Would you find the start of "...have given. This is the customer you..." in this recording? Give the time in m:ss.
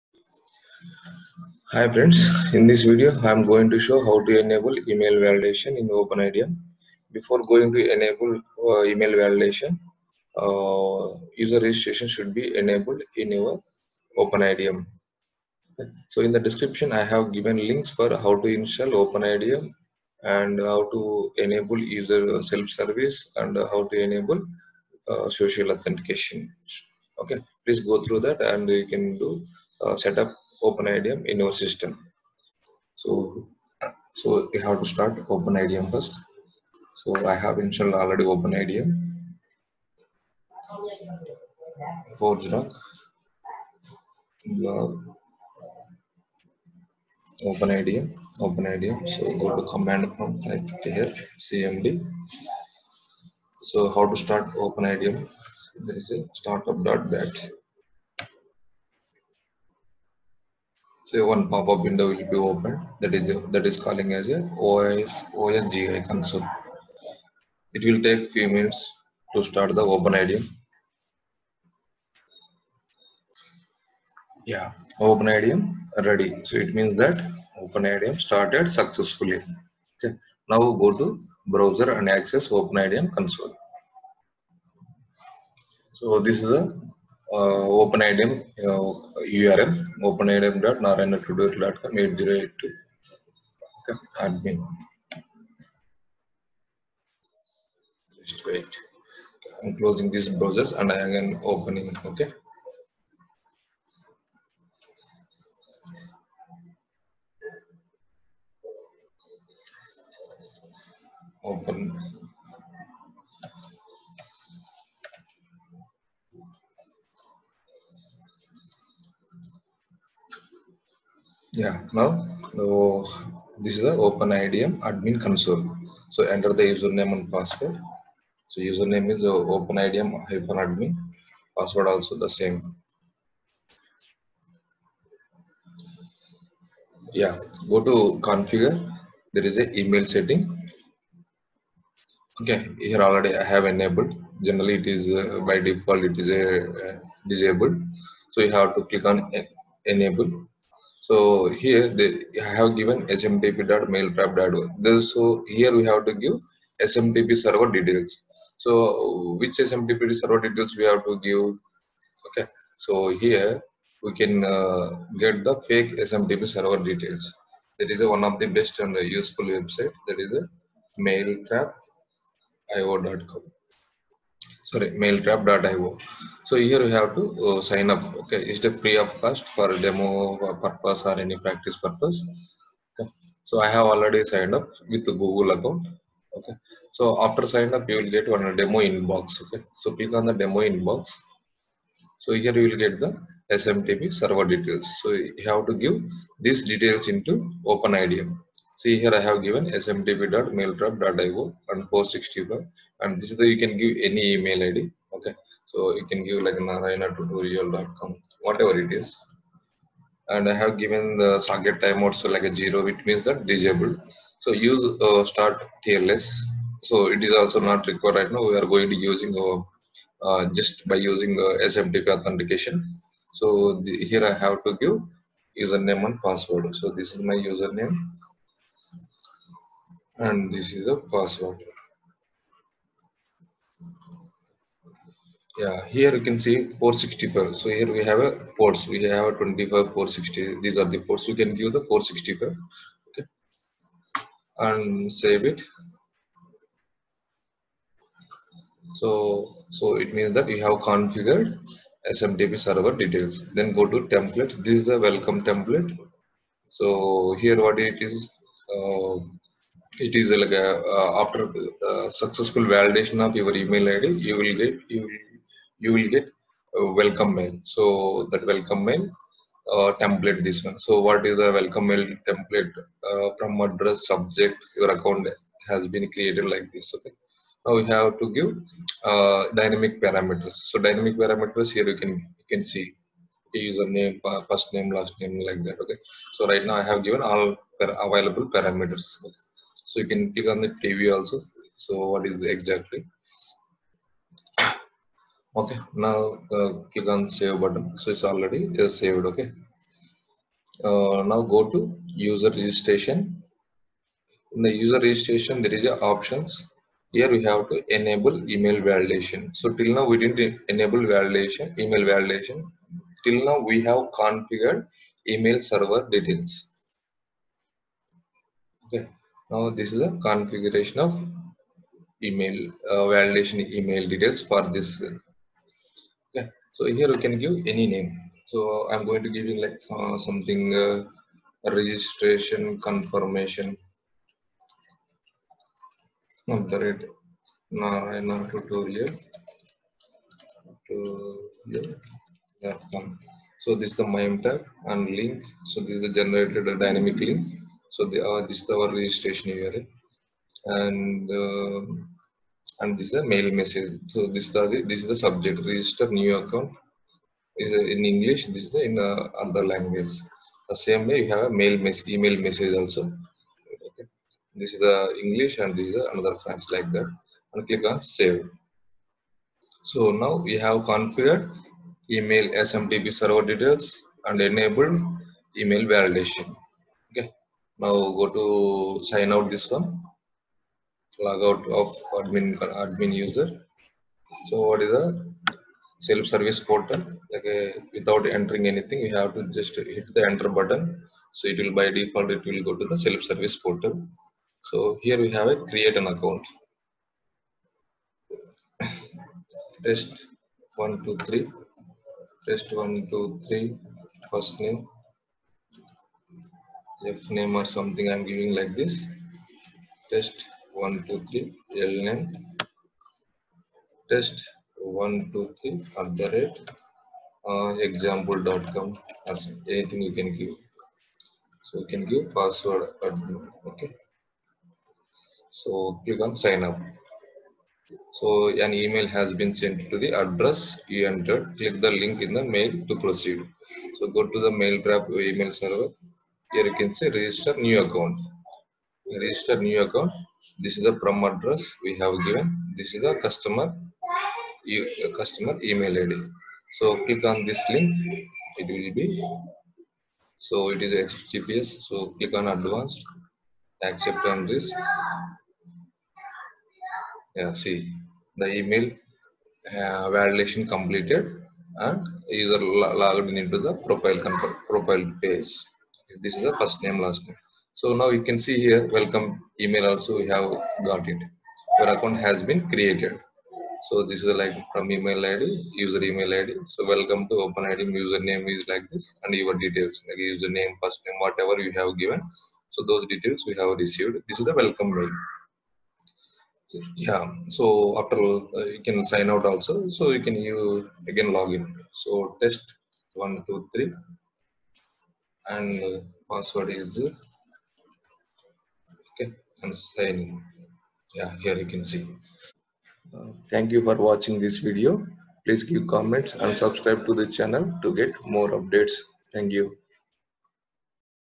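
7:21.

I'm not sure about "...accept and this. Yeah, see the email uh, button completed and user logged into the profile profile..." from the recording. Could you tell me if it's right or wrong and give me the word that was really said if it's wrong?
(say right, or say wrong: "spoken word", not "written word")
wrong: "validation", not "button".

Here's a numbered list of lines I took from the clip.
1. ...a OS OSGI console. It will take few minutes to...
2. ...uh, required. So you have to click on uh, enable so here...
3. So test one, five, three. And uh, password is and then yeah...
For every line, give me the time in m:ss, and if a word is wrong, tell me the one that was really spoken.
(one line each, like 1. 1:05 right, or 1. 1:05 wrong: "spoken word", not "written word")
1. 1:04 right
2. 2:26 wrong: "disabled", not "required"
3. 8:11 wrong: "two", not "five".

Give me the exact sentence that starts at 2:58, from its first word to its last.
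Okay, is the free of cost for demo purpose or any practice purpose.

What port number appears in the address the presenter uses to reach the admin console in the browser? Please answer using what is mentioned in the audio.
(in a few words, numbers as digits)
8082.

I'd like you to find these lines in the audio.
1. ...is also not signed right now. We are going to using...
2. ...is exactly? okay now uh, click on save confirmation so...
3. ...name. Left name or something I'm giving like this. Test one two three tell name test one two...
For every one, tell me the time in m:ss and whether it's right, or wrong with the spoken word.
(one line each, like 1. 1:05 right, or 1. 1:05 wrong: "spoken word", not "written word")
1. 3:37 wrong: "required", not "signed"
2. 4:52 wrong: "button", not "confirmation"
3. 6:44 right.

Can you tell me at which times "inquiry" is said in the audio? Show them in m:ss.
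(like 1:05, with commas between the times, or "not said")
not said.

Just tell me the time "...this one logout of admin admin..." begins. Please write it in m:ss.
6:19.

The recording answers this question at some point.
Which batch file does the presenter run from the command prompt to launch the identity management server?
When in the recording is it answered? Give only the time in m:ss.
0:56.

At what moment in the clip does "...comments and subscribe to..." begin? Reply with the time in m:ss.
8:25.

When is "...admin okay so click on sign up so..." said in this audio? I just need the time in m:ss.
7:03.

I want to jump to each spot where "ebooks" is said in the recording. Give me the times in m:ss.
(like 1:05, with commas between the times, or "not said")
not said.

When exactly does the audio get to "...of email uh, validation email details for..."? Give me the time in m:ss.
5:21.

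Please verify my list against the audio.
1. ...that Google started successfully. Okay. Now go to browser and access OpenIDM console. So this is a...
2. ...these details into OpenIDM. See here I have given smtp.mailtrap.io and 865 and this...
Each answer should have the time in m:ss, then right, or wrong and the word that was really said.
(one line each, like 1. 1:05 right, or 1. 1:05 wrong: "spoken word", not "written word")
1. 1:17 wrong: "OpenIDM", not "Google"
2. 3:16 wrong: "465", not "865".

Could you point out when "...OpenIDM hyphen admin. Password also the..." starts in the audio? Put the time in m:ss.
2:09.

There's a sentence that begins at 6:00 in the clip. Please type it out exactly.
The same way you have a mail message, email message also.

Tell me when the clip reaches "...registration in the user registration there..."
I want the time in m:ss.
5:02.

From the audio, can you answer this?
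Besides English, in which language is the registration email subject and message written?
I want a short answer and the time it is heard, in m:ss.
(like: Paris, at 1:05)
French, at 6:06.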